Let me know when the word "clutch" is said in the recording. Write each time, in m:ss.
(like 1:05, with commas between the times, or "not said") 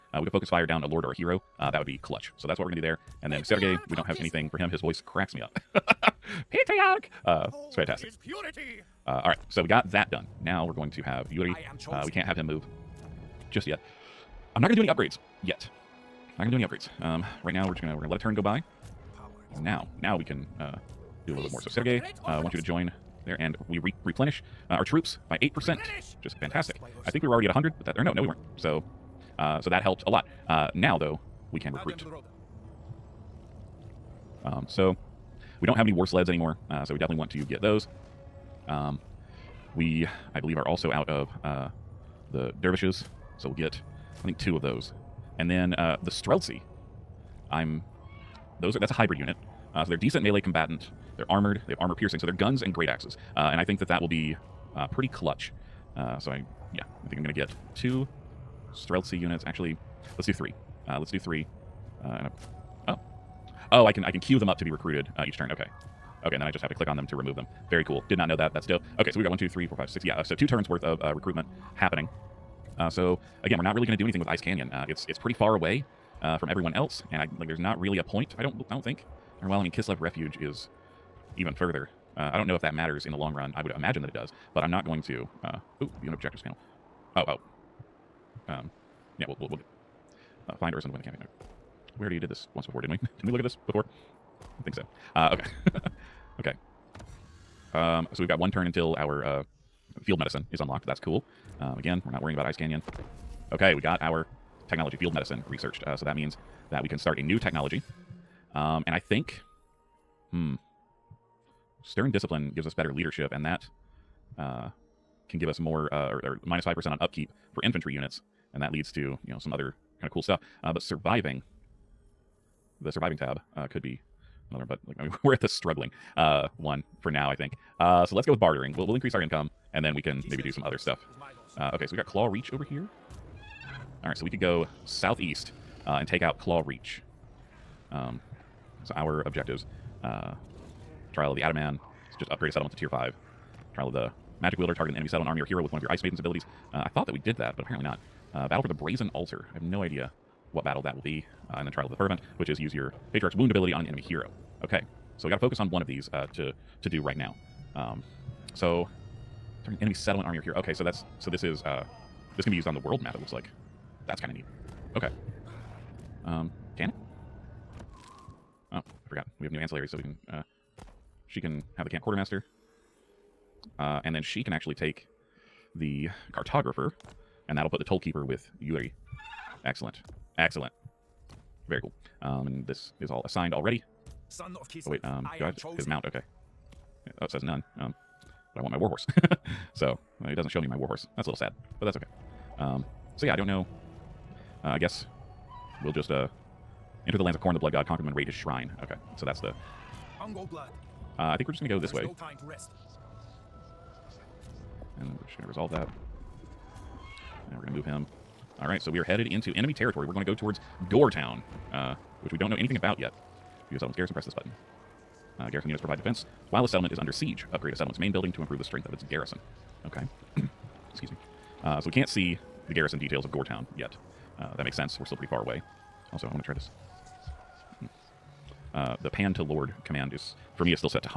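0:02, 0:55.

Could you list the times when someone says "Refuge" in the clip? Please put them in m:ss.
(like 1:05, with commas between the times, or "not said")
1:20.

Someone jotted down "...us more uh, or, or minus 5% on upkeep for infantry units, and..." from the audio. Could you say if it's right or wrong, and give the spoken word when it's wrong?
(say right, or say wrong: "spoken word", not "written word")
right.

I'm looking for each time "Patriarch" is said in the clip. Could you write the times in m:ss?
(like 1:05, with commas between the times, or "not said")
0:06, 2:33.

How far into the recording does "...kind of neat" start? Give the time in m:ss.
2:44.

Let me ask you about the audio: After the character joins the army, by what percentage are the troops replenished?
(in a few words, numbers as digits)
8%.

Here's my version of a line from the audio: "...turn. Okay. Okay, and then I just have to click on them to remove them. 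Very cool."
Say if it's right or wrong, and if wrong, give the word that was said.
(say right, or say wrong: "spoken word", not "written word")
right.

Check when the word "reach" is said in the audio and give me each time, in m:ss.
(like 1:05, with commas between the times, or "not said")
2:12, 2:16.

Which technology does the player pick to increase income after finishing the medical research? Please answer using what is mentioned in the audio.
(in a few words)
Bartering.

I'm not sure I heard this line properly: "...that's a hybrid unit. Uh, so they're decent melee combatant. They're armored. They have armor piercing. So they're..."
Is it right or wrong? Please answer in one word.
right.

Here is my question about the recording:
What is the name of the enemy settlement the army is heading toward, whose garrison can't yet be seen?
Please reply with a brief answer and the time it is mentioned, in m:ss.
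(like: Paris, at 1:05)
Gore Town, at 3:30.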